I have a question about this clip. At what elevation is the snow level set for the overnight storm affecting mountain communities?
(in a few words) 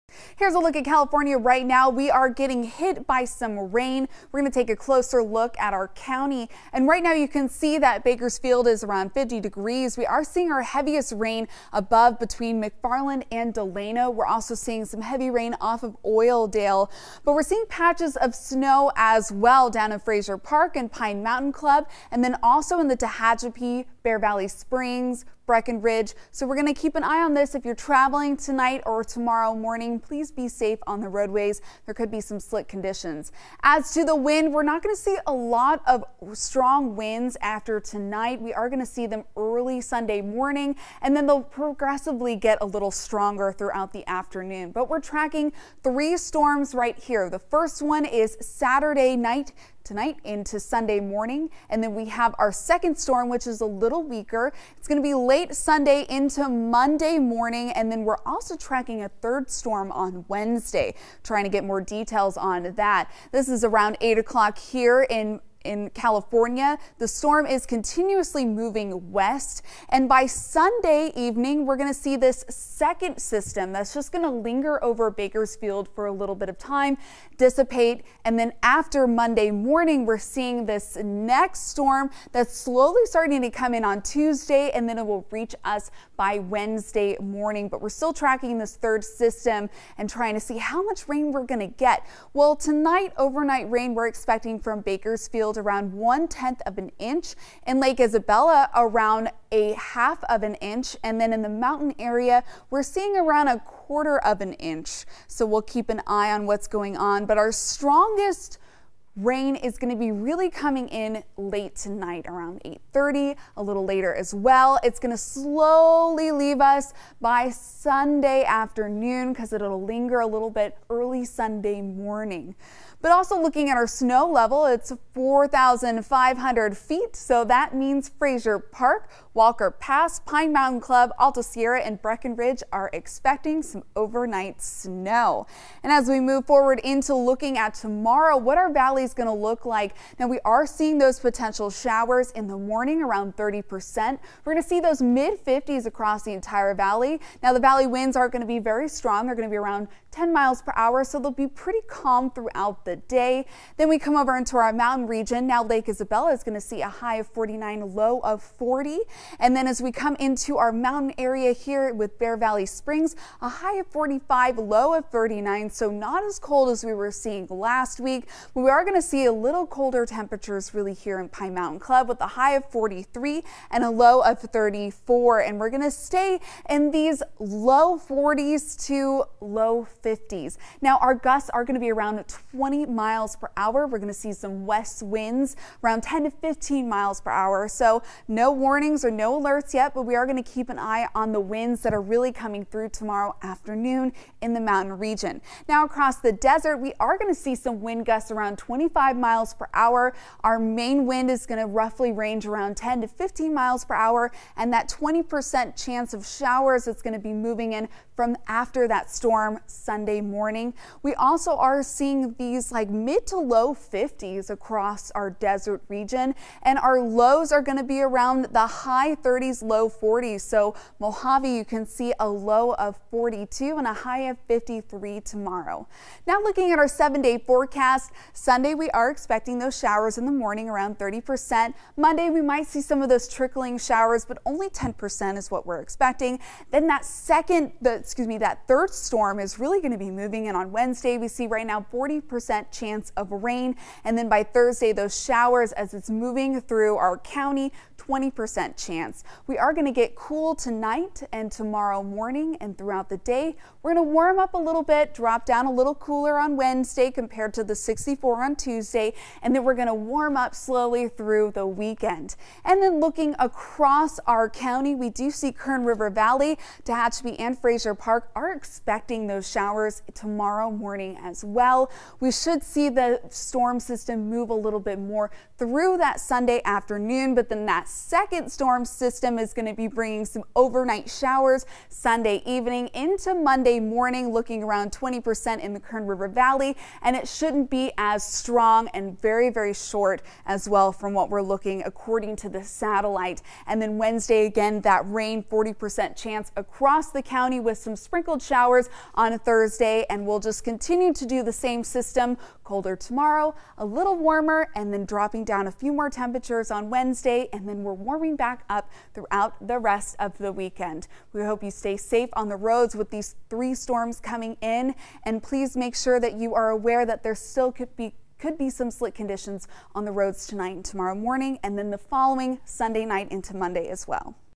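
4,500 feet.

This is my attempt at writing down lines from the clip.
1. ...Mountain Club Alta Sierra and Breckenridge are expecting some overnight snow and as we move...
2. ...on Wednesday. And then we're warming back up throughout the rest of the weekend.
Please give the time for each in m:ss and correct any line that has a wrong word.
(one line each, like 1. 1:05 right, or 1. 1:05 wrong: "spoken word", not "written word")
1. 2:10 right
2. 5:06 right.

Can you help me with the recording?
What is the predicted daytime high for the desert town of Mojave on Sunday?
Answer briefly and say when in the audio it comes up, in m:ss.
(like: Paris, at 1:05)
53, at 3:43.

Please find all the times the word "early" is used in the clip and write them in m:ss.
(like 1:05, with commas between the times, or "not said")
0:39, 2:00.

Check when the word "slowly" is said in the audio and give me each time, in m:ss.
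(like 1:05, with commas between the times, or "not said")
1:22, 1:55, 4:20.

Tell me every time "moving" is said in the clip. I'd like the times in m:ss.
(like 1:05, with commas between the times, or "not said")
1:08, 3:27, 4:00, 4:06.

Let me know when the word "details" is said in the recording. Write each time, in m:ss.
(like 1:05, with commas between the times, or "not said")
1:01.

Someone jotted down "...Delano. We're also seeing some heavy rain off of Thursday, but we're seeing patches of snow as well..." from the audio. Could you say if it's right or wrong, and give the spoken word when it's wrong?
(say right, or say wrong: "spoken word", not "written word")
wrong: "Oildale", not "Thursday".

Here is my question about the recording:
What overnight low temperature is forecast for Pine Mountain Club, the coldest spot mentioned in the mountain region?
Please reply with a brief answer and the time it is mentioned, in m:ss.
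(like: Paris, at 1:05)
34, at 2:53.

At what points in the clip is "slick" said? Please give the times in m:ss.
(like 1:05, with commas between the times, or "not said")
0:32, 5:18.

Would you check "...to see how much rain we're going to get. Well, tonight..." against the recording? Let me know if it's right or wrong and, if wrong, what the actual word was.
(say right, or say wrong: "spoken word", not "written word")
right.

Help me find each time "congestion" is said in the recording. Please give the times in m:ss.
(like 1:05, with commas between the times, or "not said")
not said.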